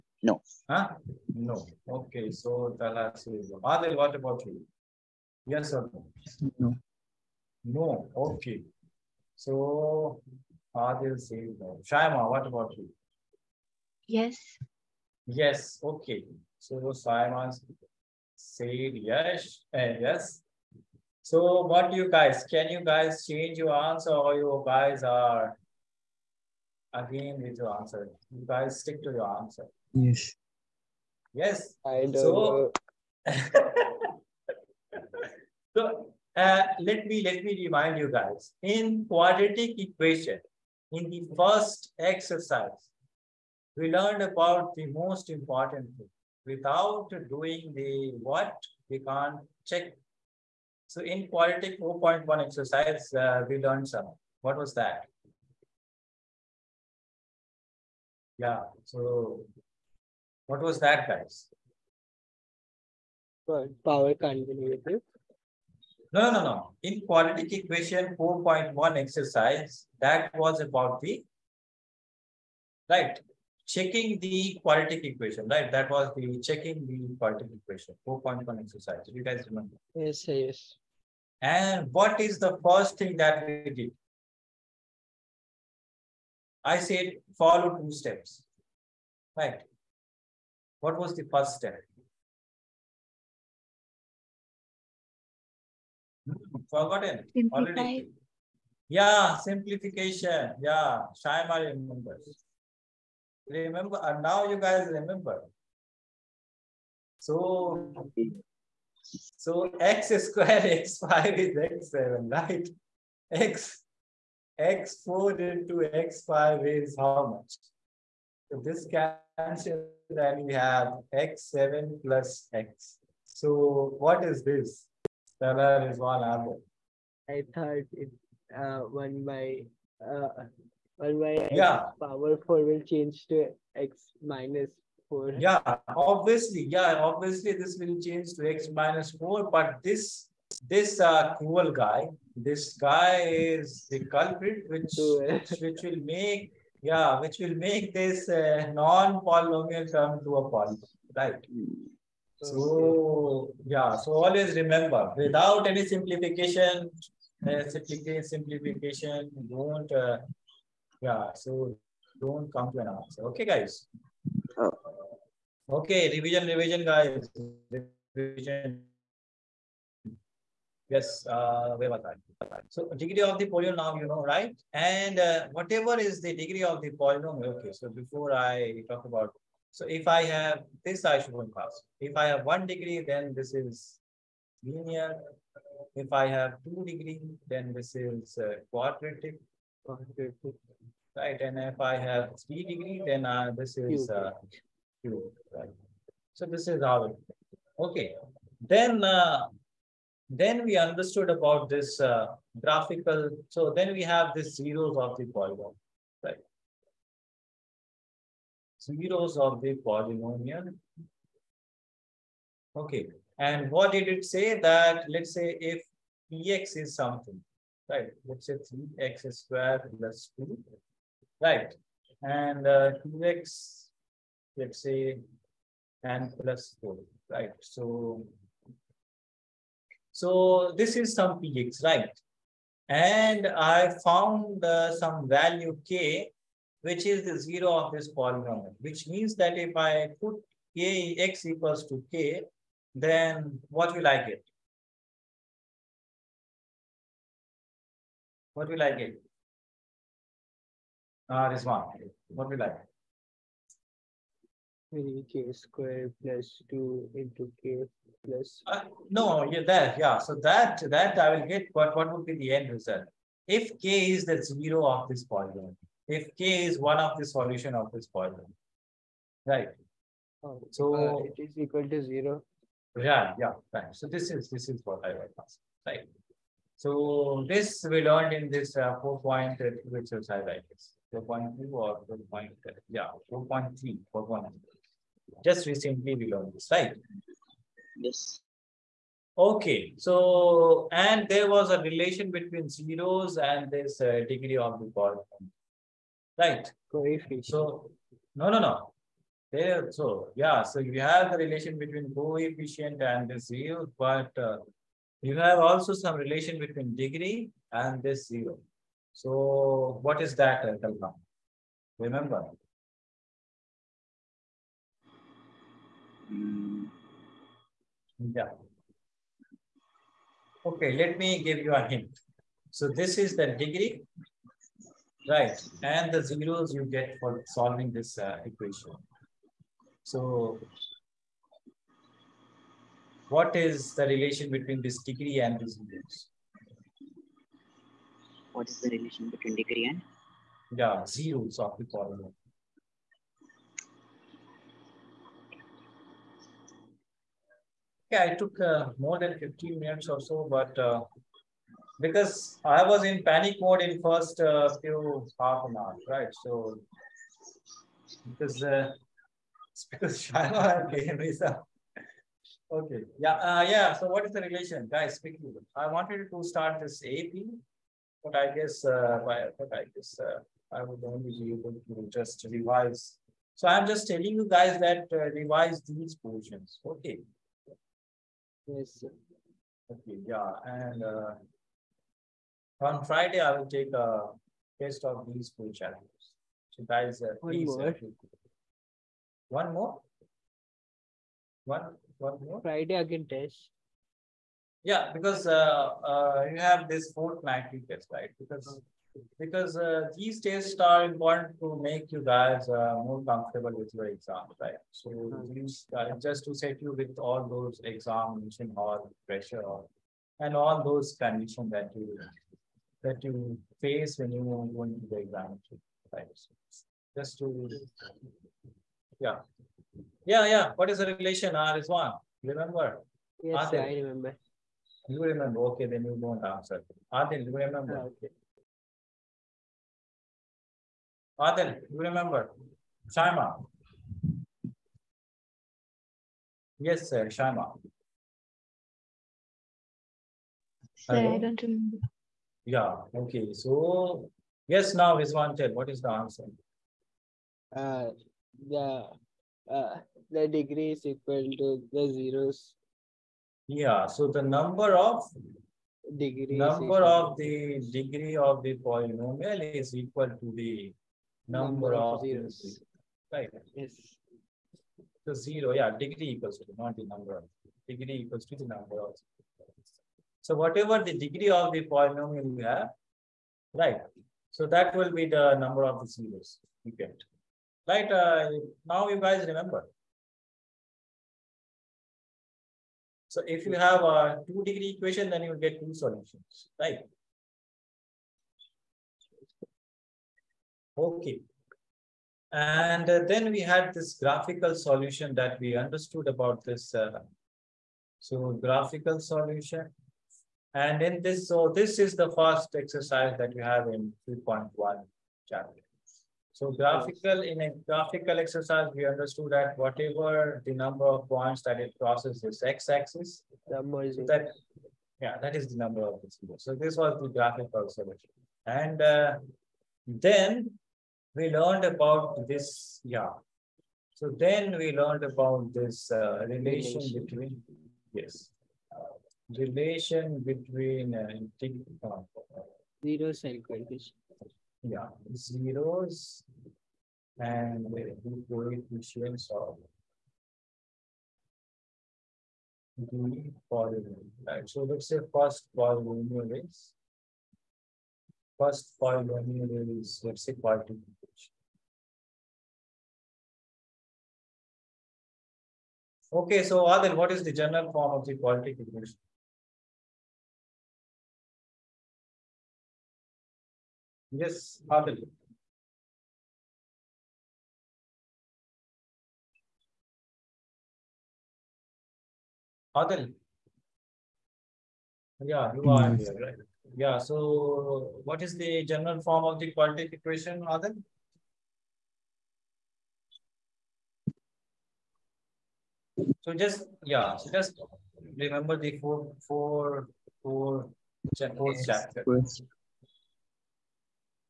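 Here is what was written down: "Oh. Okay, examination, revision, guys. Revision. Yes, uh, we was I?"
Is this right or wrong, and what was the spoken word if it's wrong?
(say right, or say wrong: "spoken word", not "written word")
wrong: "revision", not "examination".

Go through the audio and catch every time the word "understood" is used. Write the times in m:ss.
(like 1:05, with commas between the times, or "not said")
3:20, 8:15, 8:29.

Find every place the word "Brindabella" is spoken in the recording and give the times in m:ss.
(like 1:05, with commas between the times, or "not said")
not said.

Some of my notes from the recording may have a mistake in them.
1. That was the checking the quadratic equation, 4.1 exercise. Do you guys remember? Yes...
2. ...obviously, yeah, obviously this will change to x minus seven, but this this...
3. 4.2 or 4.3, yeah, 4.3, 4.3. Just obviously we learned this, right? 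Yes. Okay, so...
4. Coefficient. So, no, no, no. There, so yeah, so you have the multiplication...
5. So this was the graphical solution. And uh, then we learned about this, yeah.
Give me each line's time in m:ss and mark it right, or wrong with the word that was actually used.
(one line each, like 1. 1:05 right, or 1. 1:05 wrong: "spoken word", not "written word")
1. 1:15 right
2. 2:15 wrong: "four", not "seven"
3. 4:41 wrong: "recently", not "obviously"
4. 4:56 wrong: "relation", not "multiplication"
5. 8:36 right.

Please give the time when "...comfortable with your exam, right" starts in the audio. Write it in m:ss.
6:43.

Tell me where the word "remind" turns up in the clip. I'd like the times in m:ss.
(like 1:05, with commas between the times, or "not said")
0:37.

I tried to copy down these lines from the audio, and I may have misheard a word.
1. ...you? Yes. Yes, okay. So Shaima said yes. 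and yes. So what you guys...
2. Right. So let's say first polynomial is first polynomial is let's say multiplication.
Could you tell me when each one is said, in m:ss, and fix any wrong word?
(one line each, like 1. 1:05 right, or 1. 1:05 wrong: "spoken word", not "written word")
1. 0:12 right
2. 9:04 right.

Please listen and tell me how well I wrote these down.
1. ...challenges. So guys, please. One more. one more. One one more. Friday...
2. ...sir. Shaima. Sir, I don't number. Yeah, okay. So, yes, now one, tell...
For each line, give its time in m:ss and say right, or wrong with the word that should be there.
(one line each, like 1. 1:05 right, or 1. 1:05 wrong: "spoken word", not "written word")
1. 6:25 right
2. 7:17 wrong: "remember", not "number".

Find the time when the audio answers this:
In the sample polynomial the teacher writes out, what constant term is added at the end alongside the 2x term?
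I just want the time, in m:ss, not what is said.
3:46.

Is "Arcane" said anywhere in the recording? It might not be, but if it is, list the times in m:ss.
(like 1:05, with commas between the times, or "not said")
not said.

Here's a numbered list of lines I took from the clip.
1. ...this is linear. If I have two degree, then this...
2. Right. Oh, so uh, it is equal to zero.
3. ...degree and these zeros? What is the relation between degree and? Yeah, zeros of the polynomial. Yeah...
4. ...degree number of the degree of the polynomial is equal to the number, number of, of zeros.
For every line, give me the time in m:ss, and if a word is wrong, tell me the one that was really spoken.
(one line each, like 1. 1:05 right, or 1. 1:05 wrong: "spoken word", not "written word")
1. 3:03 right
2. 4:29 right
3. 5:35 right
4. 7:36 right.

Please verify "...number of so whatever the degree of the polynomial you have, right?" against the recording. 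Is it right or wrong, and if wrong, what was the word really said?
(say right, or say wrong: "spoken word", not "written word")
right.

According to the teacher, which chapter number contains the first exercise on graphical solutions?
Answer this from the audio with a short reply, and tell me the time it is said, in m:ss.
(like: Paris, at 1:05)
3.1, at 8:24.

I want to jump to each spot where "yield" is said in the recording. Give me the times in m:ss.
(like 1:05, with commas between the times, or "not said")
5:03.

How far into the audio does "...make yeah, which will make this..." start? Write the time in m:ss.
2:26.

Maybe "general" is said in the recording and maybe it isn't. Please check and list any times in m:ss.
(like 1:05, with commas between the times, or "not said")
9:17, 9:38.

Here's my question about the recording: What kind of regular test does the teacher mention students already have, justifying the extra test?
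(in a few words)
fortnightly test.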